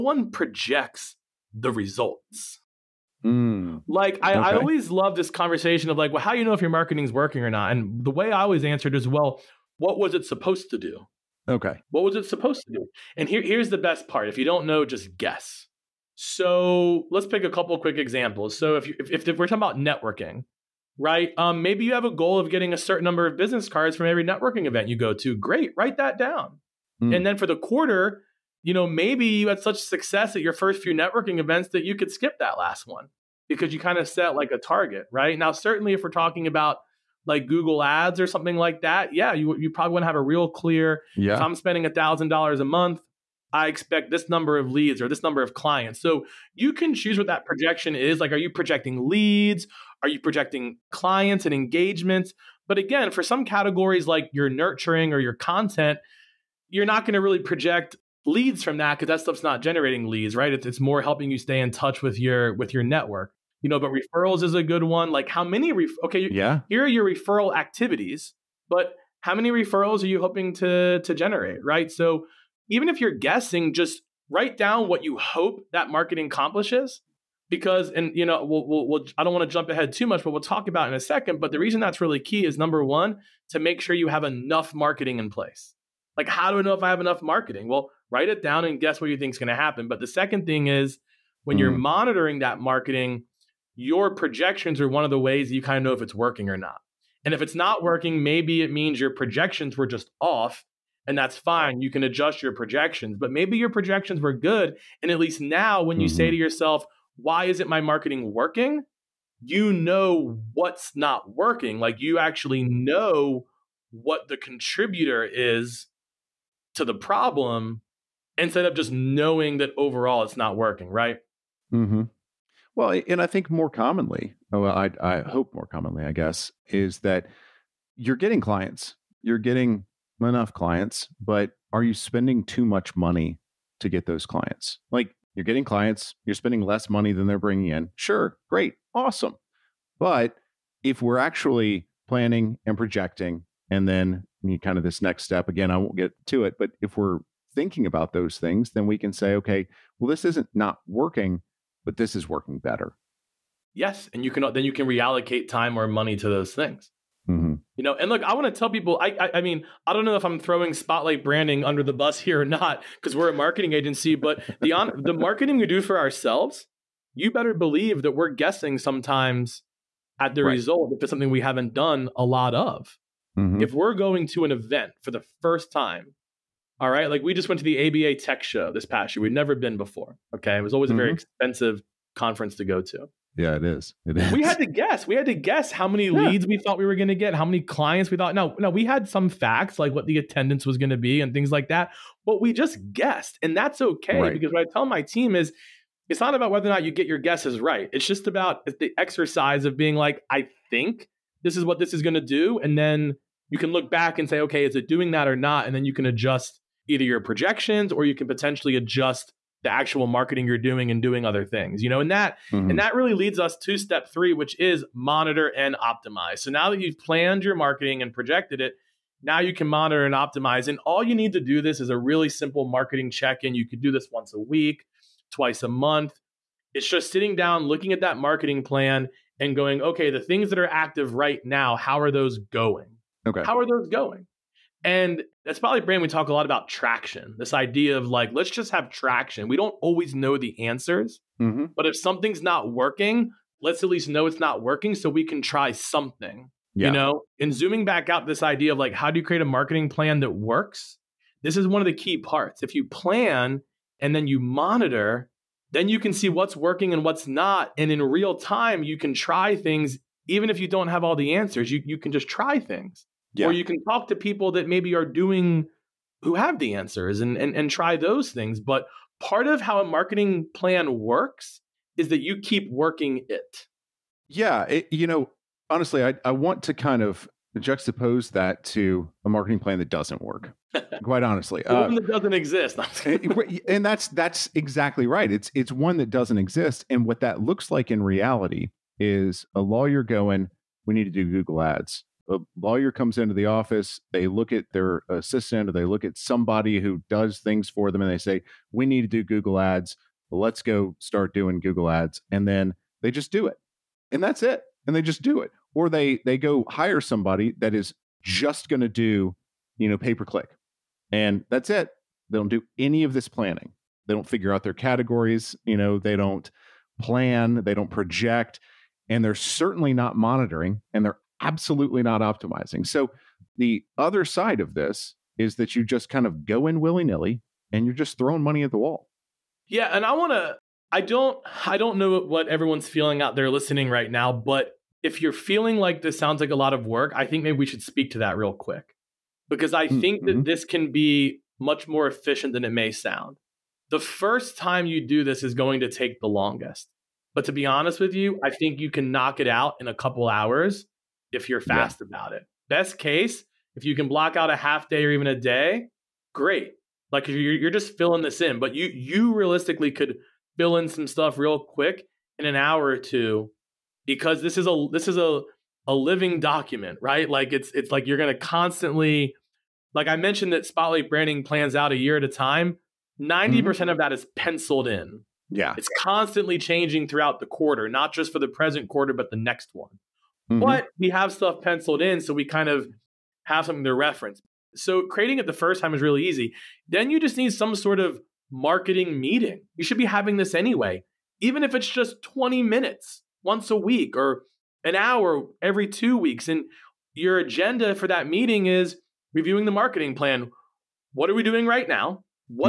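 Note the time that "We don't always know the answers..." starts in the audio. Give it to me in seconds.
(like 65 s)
239 s.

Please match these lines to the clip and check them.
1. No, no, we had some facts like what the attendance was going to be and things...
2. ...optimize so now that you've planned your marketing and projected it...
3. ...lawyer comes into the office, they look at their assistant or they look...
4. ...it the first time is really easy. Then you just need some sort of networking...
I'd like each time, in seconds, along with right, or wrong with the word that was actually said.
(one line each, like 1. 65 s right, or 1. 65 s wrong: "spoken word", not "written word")
1. 188 s right
2. 215 s right
3. 292 s right
4. 385 s wrong: "marketing", not "networking".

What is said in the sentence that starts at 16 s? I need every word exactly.
So let's pick a couple quick examples.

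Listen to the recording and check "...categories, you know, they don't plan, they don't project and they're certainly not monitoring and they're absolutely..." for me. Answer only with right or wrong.
right.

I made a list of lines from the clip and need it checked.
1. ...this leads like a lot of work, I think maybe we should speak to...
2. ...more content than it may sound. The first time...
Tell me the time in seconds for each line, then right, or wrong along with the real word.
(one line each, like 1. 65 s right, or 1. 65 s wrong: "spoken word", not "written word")
1. 336 s wrong: "sounds", not "leads"
2. 341 s wrong: "efficient", not "content".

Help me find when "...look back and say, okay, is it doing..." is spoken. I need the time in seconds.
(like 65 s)
203 s.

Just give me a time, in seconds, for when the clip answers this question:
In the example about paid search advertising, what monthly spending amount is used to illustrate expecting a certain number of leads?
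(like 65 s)
41 s.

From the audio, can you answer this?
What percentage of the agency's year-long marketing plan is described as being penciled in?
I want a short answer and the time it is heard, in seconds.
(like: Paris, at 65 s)
90%, at 373 s.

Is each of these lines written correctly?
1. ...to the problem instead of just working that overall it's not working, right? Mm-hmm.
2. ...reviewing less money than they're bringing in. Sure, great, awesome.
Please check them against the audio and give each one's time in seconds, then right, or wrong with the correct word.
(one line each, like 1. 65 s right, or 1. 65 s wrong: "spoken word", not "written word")
1. 116 s wrong: "knowing", not "working"
2. 136 s wrong: "spending", not "reviewing".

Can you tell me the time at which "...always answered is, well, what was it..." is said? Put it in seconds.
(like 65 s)
8 s.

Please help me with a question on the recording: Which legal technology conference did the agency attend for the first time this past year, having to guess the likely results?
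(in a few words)
ABA Tech Show.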